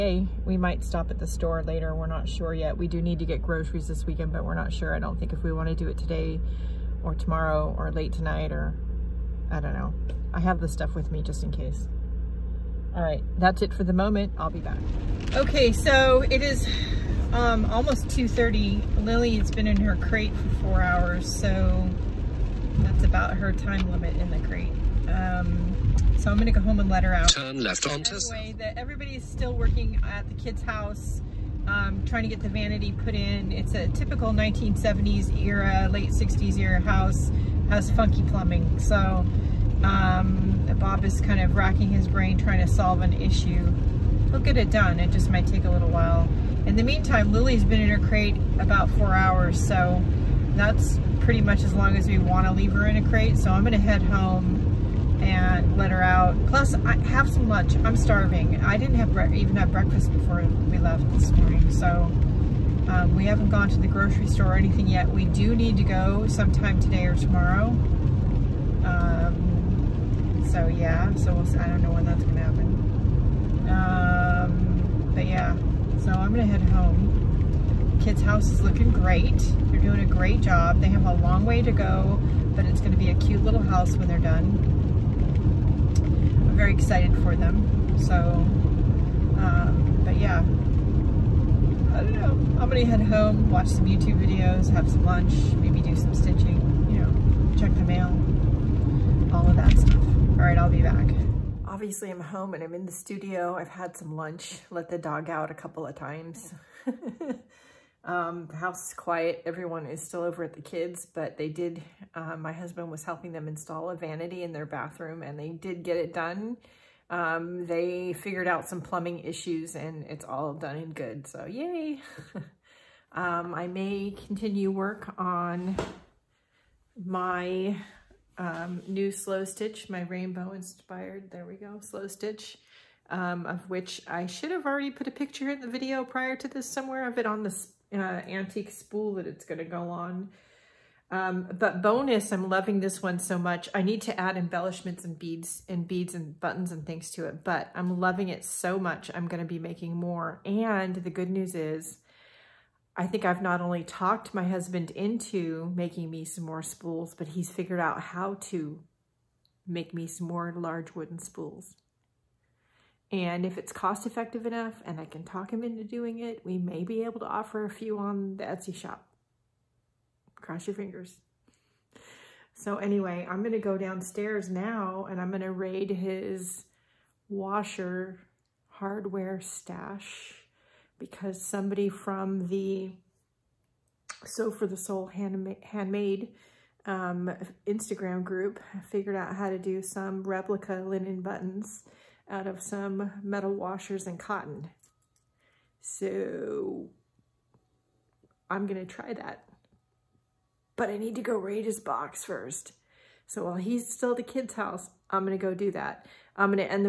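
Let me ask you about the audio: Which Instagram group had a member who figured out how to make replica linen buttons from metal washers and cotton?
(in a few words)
Sew For The Soul.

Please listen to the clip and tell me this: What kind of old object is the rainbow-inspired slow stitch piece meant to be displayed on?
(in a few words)
antique spool.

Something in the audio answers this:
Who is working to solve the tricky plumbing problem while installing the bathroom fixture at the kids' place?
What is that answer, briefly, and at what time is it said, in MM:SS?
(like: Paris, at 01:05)
Bob, at 00:40.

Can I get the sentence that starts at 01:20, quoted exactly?
They have a long way to go, but it's gonna be a cute little house when they're done very excited for them.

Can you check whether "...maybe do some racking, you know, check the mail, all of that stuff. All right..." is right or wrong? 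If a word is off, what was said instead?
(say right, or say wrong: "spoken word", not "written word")
wrong: "stitching", not "racking".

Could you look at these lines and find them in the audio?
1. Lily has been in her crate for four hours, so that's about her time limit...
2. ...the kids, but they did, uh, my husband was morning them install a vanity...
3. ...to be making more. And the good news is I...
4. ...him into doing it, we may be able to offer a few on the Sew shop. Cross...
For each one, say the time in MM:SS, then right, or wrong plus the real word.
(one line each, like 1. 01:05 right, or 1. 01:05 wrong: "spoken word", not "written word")
1. 00:19 right
2. 01:50 wrong: "helping", not "morning"
3. 02:29 right
4. 02:45 wrong: "Etsy", not "Sew".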